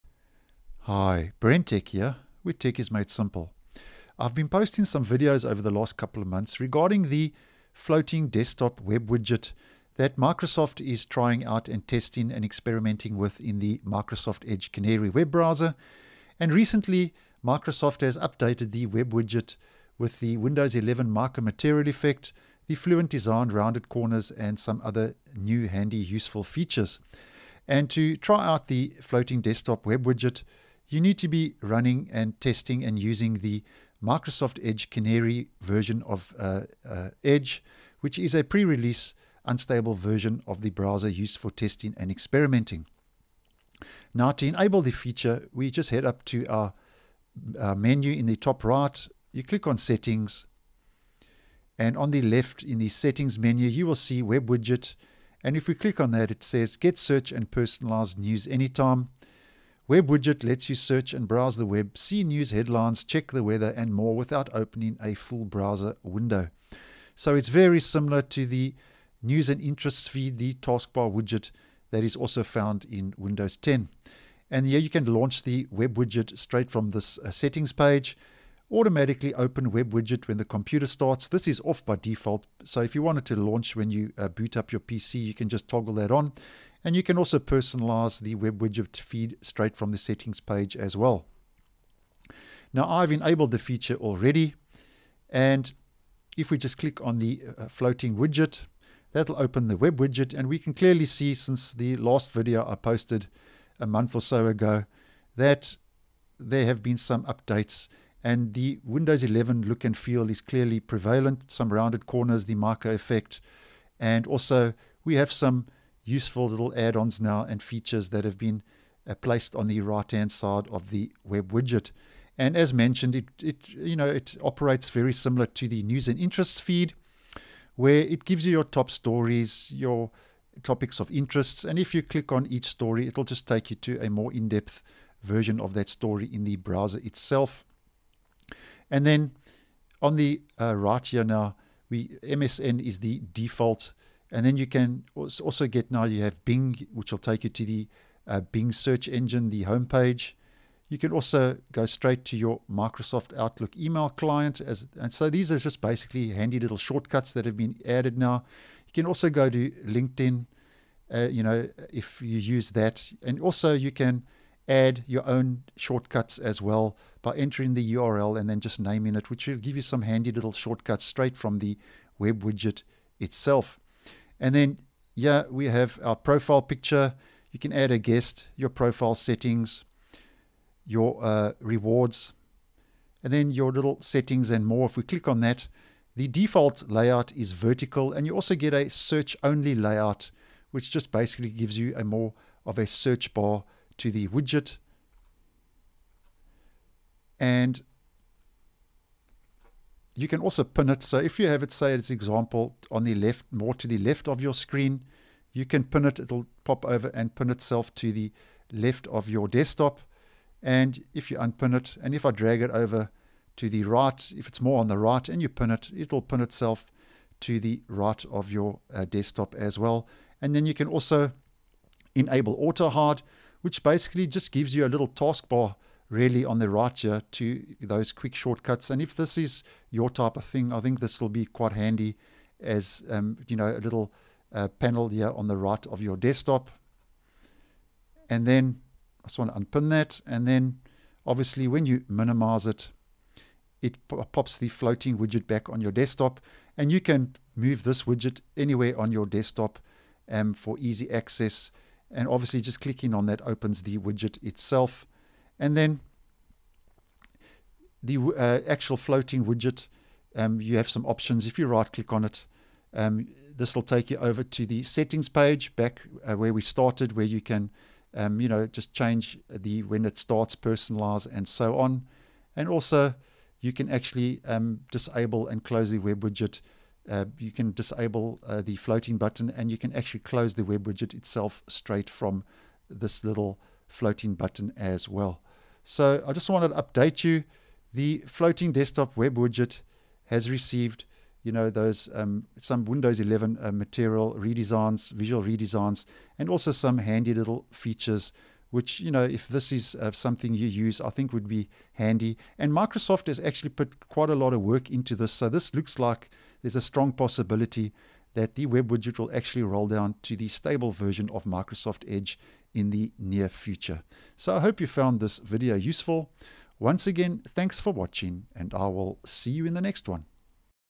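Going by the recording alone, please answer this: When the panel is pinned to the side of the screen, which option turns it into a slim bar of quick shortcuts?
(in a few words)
auto hide.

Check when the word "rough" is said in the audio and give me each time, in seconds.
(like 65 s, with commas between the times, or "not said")
not said.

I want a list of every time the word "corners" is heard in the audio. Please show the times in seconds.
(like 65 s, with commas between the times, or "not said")
23 s, 112 s.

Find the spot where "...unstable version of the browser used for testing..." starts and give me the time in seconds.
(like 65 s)
39 s.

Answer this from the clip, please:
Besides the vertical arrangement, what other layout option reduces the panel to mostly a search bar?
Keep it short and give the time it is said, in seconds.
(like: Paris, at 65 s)
search only, at 188 s.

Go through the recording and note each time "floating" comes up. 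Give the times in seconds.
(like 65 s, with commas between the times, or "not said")
7 s, 28 s, 97 s, 244 s, 258 s, 278 s, 283 s, 288 s.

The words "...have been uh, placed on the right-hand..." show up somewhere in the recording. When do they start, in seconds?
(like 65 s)
118 s.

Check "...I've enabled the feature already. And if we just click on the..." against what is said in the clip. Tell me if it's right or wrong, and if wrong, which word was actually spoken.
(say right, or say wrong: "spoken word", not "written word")
right.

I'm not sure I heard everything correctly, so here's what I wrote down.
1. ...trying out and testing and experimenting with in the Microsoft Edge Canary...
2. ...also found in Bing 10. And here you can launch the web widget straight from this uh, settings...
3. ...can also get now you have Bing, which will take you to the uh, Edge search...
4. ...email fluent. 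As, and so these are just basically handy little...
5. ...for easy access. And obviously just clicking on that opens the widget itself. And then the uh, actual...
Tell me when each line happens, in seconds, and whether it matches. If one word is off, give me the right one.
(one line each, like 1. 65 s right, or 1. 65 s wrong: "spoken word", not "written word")
1. 11 s right
2. 72 s wrong: "Windows", not "Bing"
3. 144 s wrong: "Bing", not "Edge"
4. 153 s wrong: "client", not "fluent"
5. 250 s right.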